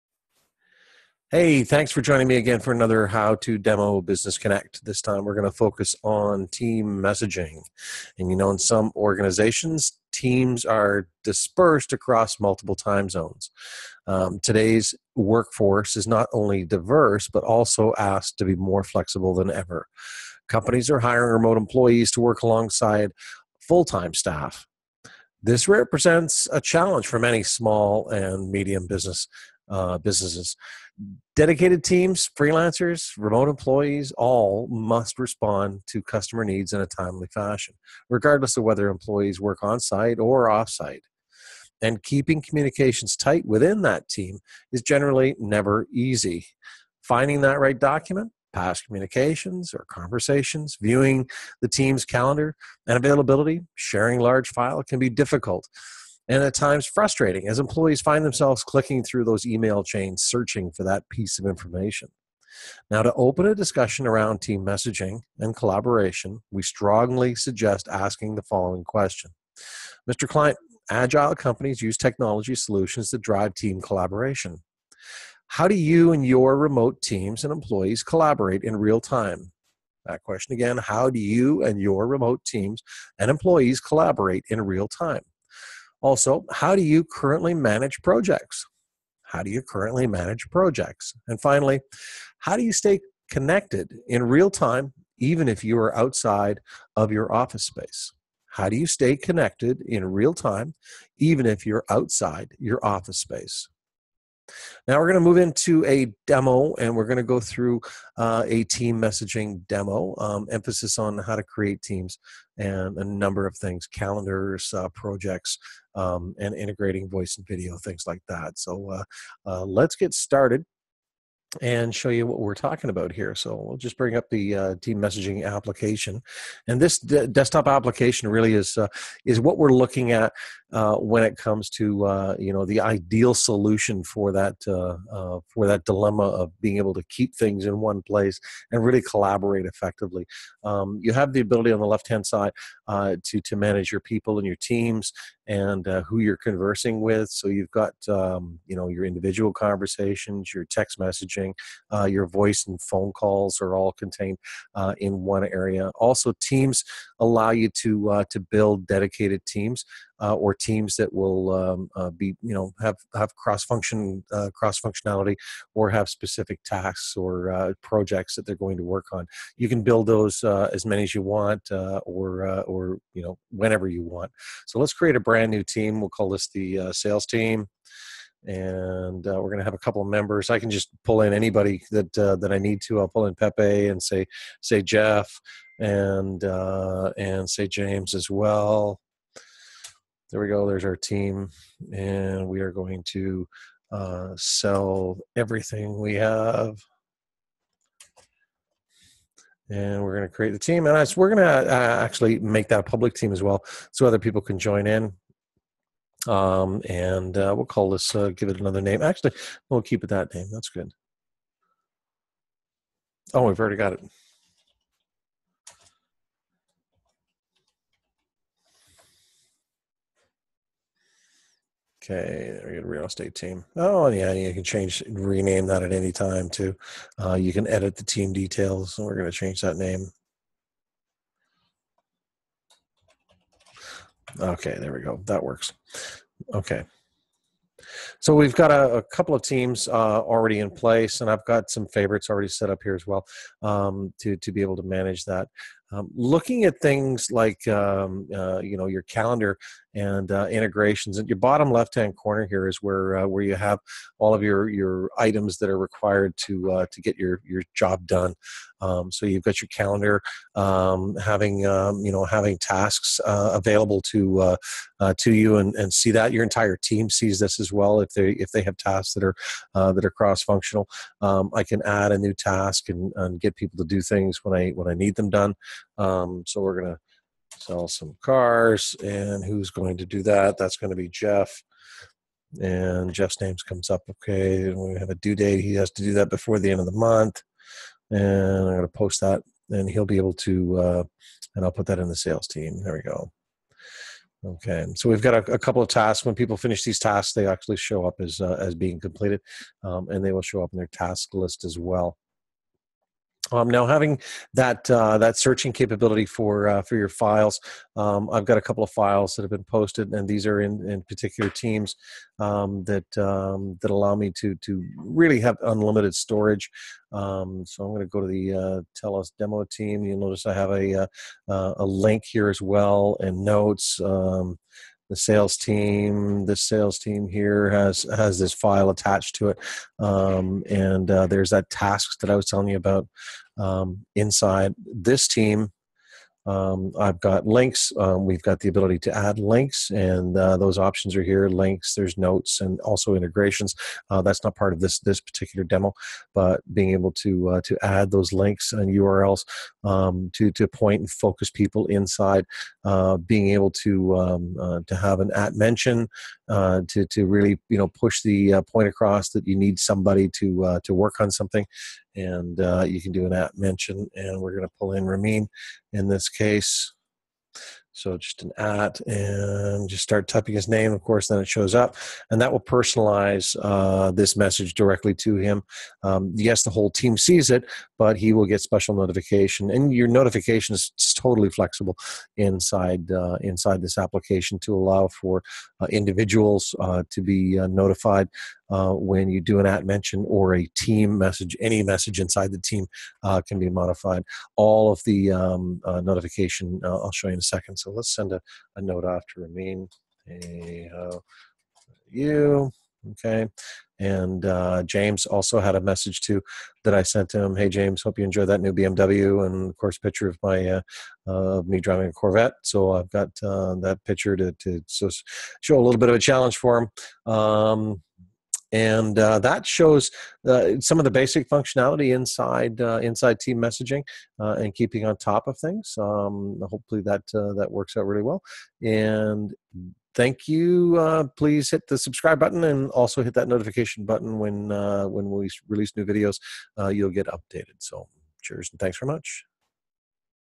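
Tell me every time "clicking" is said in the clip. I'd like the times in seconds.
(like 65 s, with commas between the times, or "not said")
58 s.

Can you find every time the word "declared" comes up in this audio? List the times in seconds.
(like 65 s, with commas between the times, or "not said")
not said.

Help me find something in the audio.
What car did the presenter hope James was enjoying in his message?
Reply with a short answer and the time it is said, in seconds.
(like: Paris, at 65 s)
BMW, at 408 s.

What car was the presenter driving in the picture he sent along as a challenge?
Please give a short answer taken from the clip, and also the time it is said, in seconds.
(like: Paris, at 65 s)
Corvette, at 412 s.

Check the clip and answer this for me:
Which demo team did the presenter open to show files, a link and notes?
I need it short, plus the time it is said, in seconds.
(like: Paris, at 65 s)
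Telos demo team, at 318 s.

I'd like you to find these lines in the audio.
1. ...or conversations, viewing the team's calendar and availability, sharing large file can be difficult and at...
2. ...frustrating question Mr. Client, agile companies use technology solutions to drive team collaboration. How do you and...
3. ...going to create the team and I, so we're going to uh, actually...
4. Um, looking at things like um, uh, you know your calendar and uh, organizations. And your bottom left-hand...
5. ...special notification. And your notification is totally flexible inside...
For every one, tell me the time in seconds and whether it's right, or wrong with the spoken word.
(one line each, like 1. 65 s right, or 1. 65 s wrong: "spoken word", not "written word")
1. 49 s right
2. 68 s wrong: "following", not "frustrating"
3. 200 s right
4. 245 s wrong: "integrations", not "organizations"
5. 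378 s right.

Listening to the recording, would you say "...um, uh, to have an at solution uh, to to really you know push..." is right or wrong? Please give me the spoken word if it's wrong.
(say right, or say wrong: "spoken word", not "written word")
wrong: "mention", not "solution".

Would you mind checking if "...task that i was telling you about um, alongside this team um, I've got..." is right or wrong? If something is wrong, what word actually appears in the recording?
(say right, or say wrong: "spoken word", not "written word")
wrong: "inside", not "alongside".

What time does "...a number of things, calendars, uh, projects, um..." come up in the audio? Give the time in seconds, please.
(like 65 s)
112 s.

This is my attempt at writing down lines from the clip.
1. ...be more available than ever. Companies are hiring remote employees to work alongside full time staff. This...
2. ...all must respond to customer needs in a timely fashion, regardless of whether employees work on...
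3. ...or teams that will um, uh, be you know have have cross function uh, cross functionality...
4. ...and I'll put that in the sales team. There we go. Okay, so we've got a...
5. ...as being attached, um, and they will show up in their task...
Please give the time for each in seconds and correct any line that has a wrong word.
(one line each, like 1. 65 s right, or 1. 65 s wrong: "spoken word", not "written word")
1. 18 s wrong: "flexible", not "available"
2. 34 s right
3. 160 s right
4. 291 s right
5. 298 s wrong: "completed", not "attached".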